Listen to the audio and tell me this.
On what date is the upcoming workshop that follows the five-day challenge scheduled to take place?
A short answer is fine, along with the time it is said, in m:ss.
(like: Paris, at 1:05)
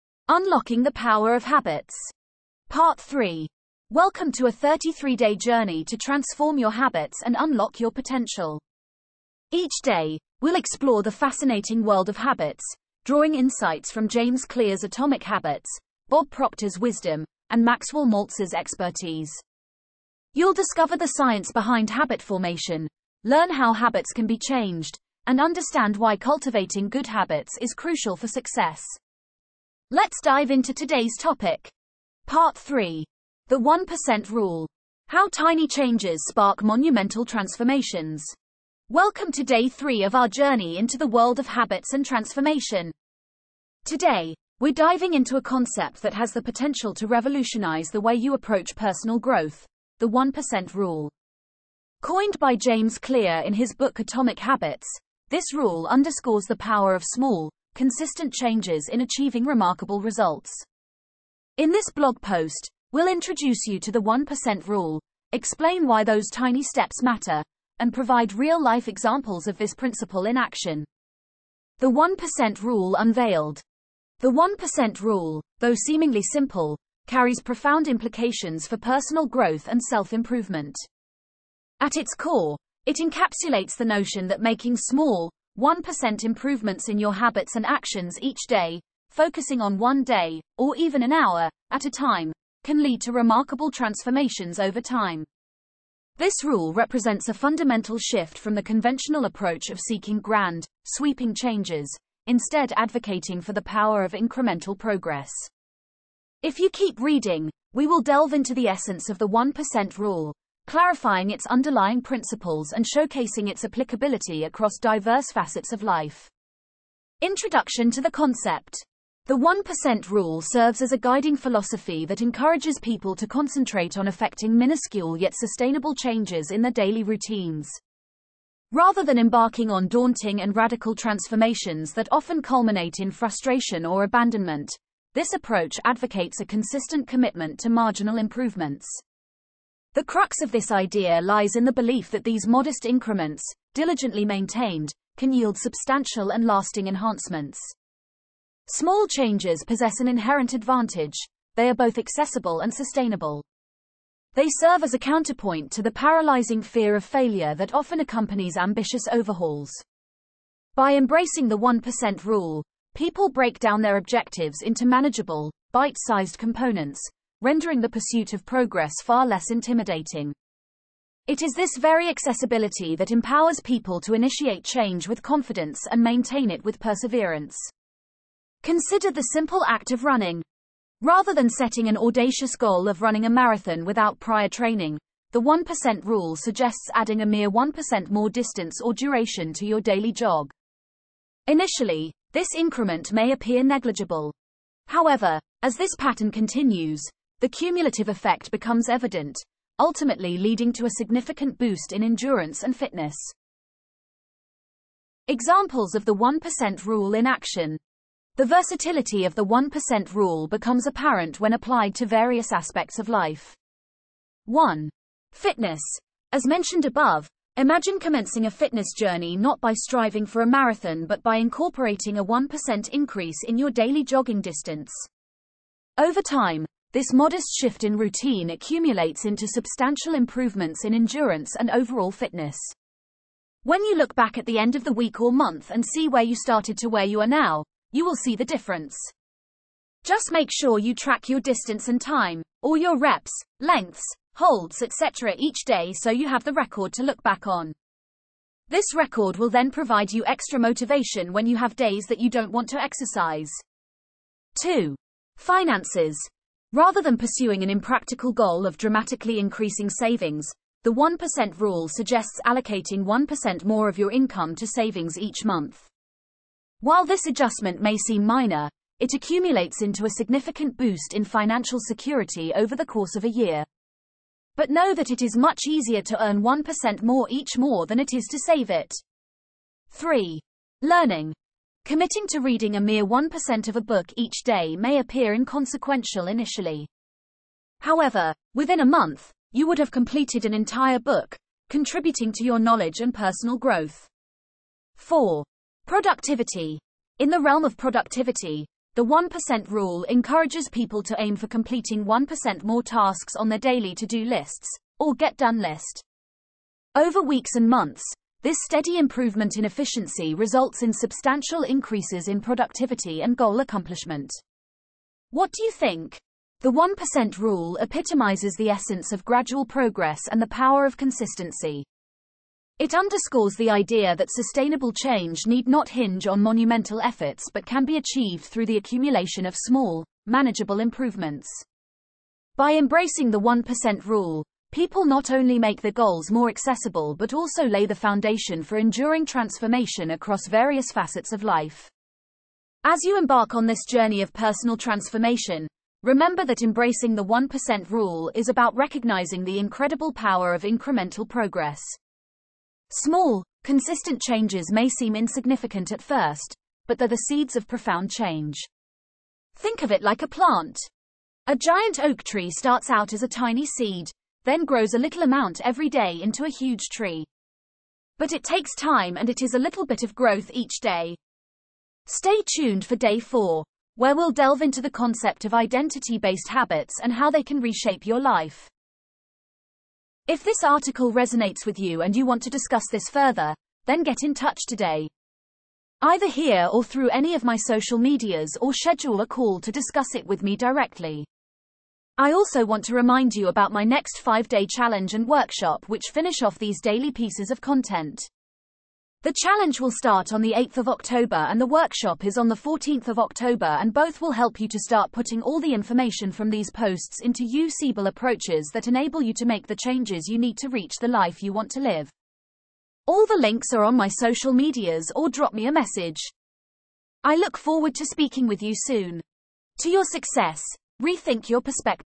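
14 October, at 6:42.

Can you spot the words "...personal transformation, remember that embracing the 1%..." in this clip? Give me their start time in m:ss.
5:44.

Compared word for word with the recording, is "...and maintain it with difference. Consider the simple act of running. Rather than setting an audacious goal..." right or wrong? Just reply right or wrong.
wrong.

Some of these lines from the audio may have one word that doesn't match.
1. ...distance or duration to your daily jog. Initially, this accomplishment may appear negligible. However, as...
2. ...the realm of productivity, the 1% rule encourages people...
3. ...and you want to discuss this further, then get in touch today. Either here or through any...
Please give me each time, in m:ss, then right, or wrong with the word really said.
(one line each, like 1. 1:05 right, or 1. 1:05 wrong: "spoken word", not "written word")
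1. 3:08 wrong: "increment", not "accomplishment"
2. 4:57 right
3. 6:22 right.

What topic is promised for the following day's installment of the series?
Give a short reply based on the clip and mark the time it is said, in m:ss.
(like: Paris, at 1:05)
identity based habits, at 6:15.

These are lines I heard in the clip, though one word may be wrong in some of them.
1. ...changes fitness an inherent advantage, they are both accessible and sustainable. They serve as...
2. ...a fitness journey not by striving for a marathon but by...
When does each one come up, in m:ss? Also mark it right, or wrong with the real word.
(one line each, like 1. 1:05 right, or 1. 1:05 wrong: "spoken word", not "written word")
1. 2:29 wrong: "possess", not "fitness"
2. 3:38 right.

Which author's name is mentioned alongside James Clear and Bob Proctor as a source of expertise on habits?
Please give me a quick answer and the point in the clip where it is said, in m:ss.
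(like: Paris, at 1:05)
Maxwell Maltz, at 0:17.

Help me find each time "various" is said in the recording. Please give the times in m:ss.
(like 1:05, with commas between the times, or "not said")
3:32, 5:40.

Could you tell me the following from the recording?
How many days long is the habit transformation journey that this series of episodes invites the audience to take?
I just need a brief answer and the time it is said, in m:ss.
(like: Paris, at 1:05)
33, at 0:04.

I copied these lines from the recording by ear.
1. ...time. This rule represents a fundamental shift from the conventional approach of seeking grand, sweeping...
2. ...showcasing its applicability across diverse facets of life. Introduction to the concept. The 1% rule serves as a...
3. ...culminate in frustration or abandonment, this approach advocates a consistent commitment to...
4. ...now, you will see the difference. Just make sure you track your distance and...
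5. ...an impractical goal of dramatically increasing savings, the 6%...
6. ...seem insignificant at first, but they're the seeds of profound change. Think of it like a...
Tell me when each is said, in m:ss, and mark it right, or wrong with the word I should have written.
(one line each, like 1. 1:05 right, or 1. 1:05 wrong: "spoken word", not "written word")
1. 1:34 right
2. 1:52 right
3. 2:12 right
4. 3:57 right
5. 4:17 wrong: "1", not "6"
6. 5:54 right.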